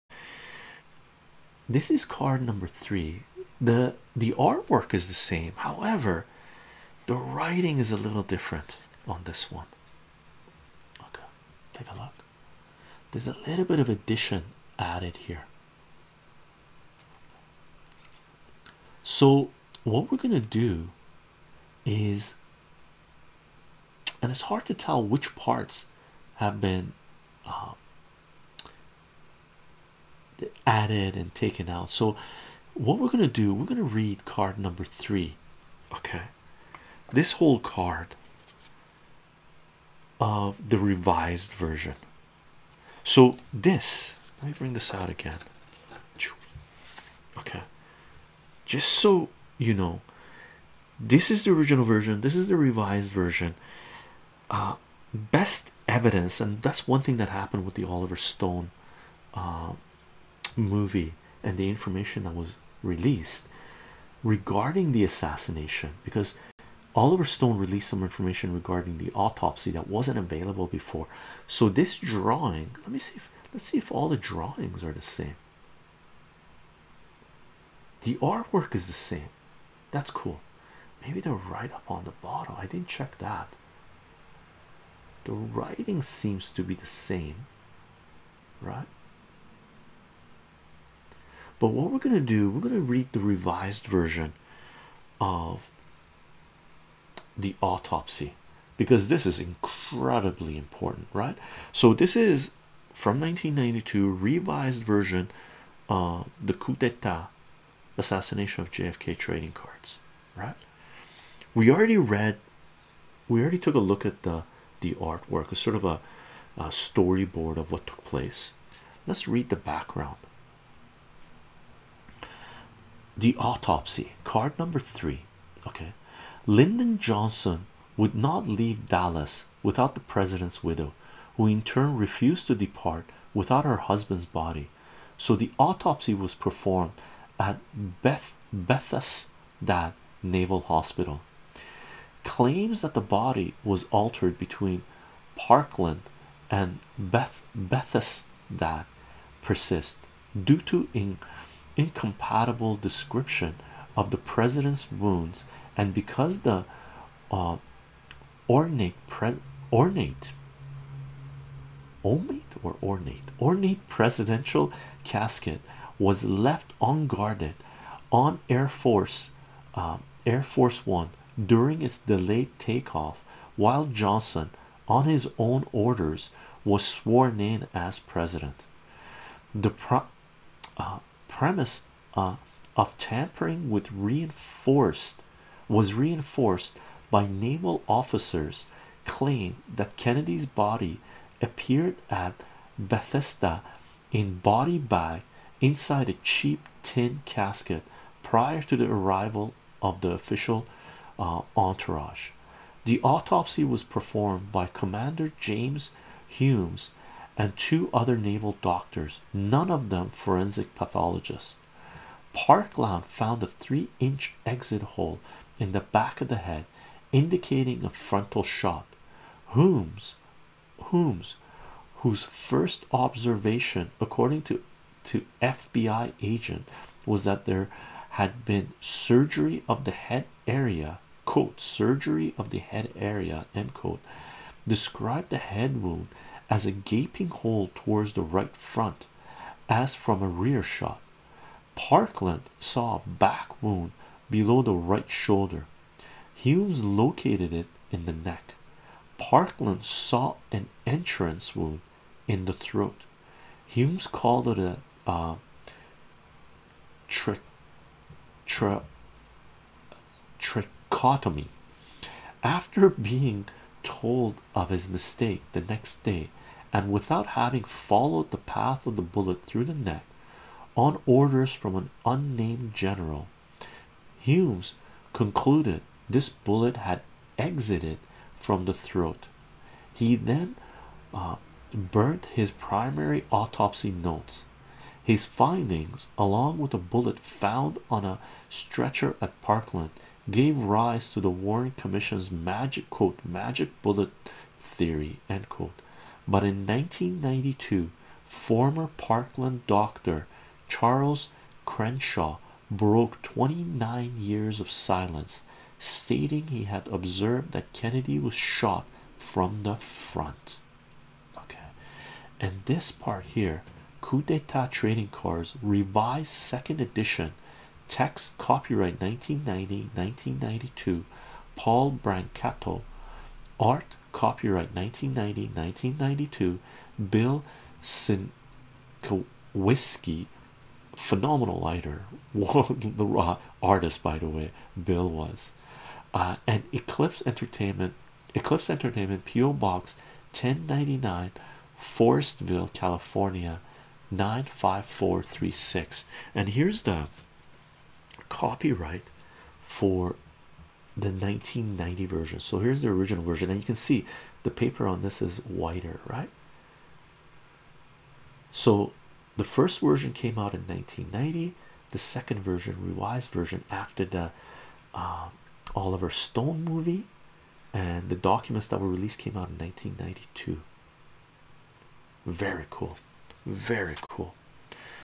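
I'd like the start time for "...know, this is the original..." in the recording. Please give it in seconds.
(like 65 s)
49 s.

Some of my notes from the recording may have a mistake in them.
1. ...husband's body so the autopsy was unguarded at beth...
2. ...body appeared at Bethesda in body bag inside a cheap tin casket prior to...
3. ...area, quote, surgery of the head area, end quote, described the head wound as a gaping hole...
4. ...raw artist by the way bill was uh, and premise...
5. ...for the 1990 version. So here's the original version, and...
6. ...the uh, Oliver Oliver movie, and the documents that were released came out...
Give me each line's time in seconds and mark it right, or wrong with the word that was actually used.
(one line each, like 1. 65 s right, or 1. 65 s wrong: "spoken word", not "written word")
1. 133 s wrong: "performed", not "unguarded"
2. 190 s right
3. 230 s right
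4. 333 s wrong: "eclipse", not "premise"
5. 349 s right
6. 364 s wrong: "Stone", not "Oliver".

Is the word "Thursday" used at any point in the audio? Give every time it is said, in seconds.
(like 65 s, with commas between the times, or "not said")
not said.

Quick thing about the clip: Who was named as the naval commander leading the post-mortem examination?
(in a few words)
James Humes.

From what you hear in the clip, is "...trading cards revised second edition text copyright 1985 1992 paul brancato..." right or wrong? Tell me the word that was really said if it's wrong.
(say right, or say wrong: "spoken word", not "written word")
wrong: "1990", not "1985".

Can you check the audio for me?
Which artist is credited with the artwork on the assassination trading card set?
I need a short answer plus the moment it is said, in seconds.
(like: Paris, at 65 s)
Bill Sienkiewicz, at 327 s.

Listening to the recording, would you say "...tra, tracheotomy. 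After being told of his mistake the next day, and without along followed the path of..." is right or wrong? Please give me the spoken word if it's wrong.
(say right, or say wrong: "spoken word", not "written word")
wrong: "having", not "along".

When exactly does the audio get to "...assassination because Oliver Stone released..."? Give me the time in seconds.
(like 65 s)
65 s.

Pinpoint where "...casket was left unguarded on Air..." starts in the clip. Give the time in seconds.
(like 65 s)
165 s.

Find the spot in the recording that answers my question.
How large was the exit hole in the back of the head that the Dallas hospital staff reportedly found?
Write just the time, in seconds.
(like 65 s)
213 s.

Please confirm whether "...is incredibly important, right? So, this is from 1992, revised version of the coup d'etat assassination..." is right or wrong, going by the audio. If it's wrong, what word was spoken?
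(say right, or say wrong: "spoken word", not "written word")
right.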